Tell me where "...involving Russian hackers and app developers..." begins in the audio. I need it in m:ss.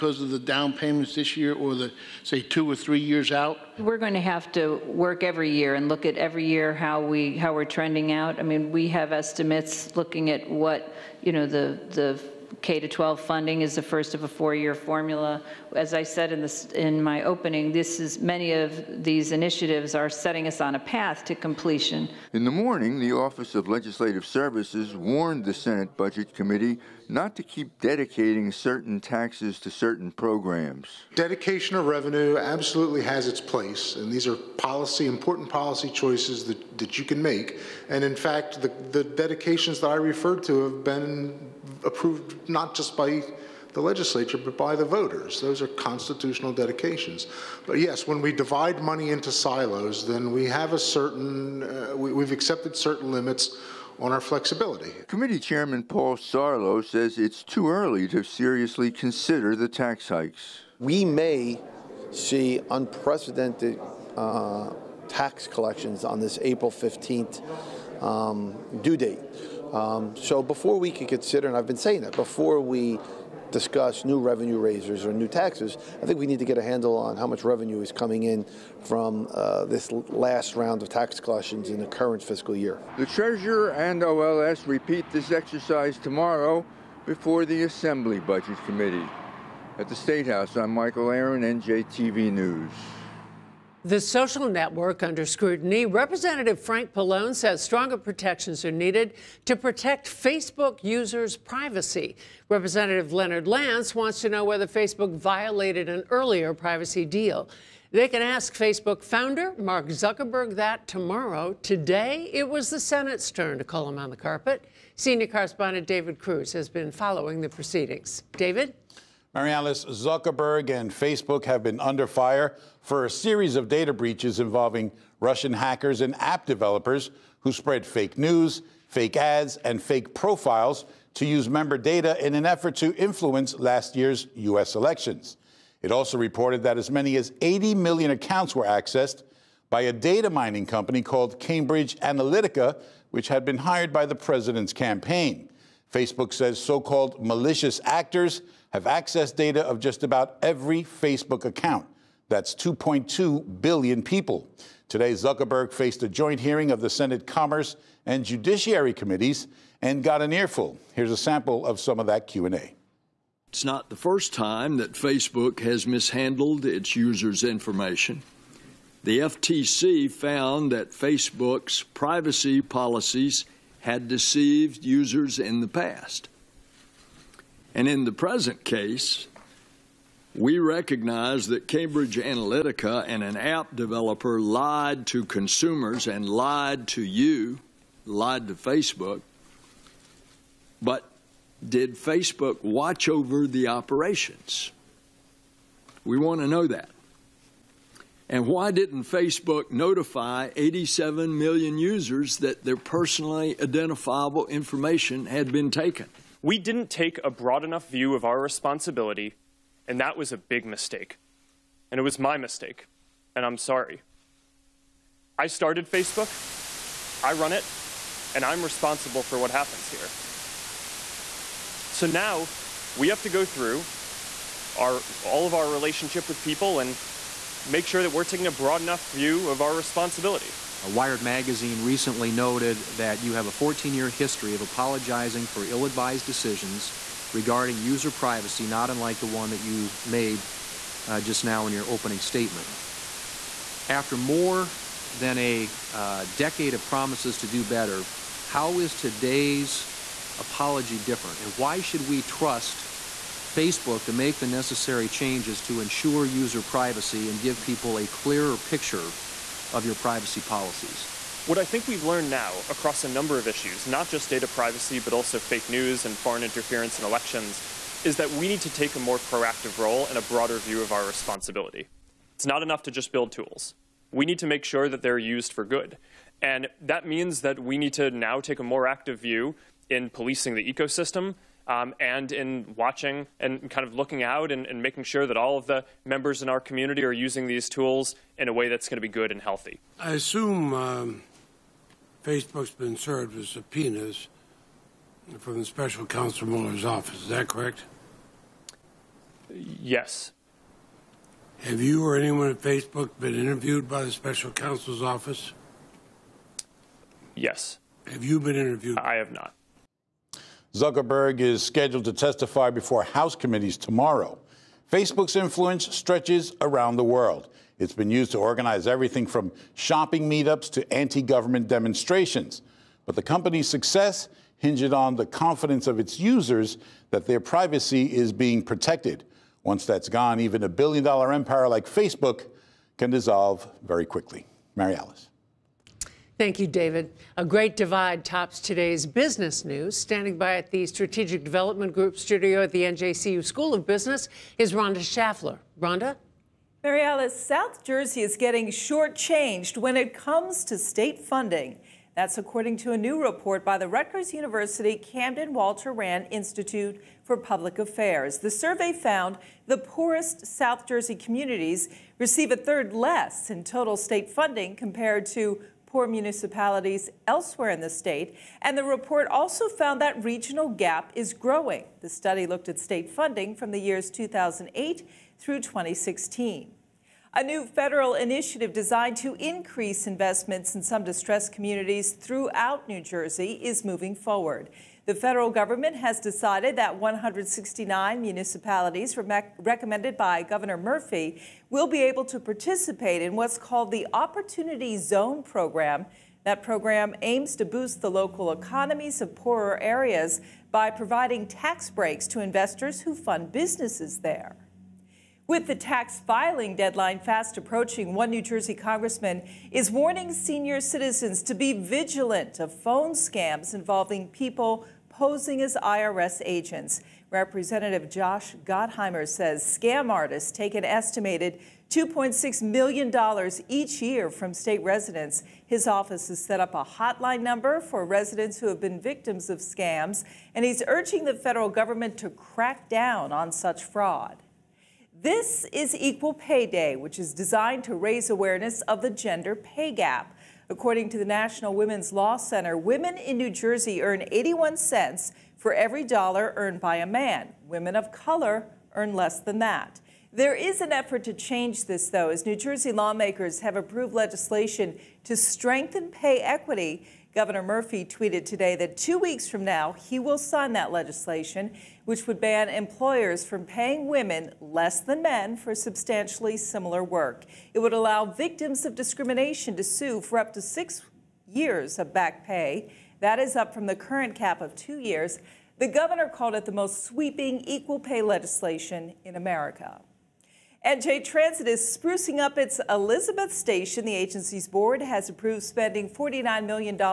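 2:04.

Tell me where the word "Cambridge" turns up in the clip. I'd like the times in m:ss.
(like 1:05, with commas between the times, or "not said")
2:21, 3:01.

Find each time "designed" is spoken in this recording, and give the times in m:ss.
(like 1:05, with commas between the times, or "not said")
6:18, 7:17.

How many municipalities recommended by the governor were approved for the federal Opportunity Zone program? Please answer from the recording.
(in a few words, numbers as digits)
169.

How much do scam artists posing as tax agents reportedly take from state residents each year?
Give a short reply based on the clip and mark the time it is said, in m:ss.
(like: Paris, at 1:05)
$2.6 million, at 7:01.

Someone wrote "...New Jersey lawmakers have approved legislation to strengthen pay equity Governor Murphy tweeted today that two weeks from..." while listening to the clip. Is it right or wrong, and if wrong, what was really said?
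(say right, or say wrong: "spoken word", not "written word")
right.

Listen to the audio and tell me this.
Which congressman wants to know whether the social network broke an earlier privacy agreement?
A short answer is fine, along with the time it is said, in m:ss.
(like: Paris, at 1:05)
Leonard Lance, at 1:43.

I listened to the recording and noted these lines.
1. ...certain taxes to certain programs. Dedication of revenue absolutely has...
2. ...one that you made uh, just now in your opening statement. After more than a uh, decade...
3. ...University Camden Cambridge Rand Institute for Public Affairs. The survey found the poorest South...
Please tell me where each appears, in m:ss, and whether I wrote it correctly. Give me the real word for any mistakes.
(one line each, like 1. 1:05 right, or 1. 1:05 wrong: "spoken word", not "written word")
1. 0:28 right
2. 3:59 right
3. 5:54 wrong: "Walter", not "Cambridge".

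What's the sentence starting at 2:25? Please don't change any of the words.
Facebook says so called malicious actors have accessed data of just about every Facebook account.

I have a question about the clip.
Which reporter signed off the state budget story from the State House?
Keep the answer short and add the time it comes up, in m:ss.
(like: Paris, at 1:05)
Michael Aron, at 1:30.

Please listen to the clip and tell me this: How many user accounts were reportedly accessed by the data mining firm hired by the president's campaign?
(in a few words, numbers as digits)
80 million.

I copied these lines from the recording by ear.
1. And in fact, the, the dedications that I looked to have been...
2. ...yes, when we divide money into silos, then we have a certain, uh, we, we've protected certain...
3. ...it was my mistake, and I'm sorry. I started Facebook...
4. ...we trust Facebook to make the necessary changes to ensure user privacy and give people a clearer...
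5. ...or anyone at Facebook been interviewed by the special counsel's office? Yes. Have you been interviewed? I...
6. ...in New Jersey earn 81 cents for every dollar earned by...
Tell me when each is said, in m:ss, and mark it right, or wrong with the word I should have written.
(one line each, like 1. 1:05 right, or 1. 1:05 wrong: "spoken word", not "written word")
1. 0:37 wrong: "referred", not "looked"
2. 0:47 wrong: "accepted", not "protected"
3. 3:31 right
4. 4:12 right
5. 5:02 right
6. 7:23 right.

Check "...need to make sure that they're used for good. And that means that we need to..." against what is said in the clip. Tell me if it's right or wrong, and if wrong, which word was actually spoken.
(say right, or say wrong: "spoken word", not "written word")
right.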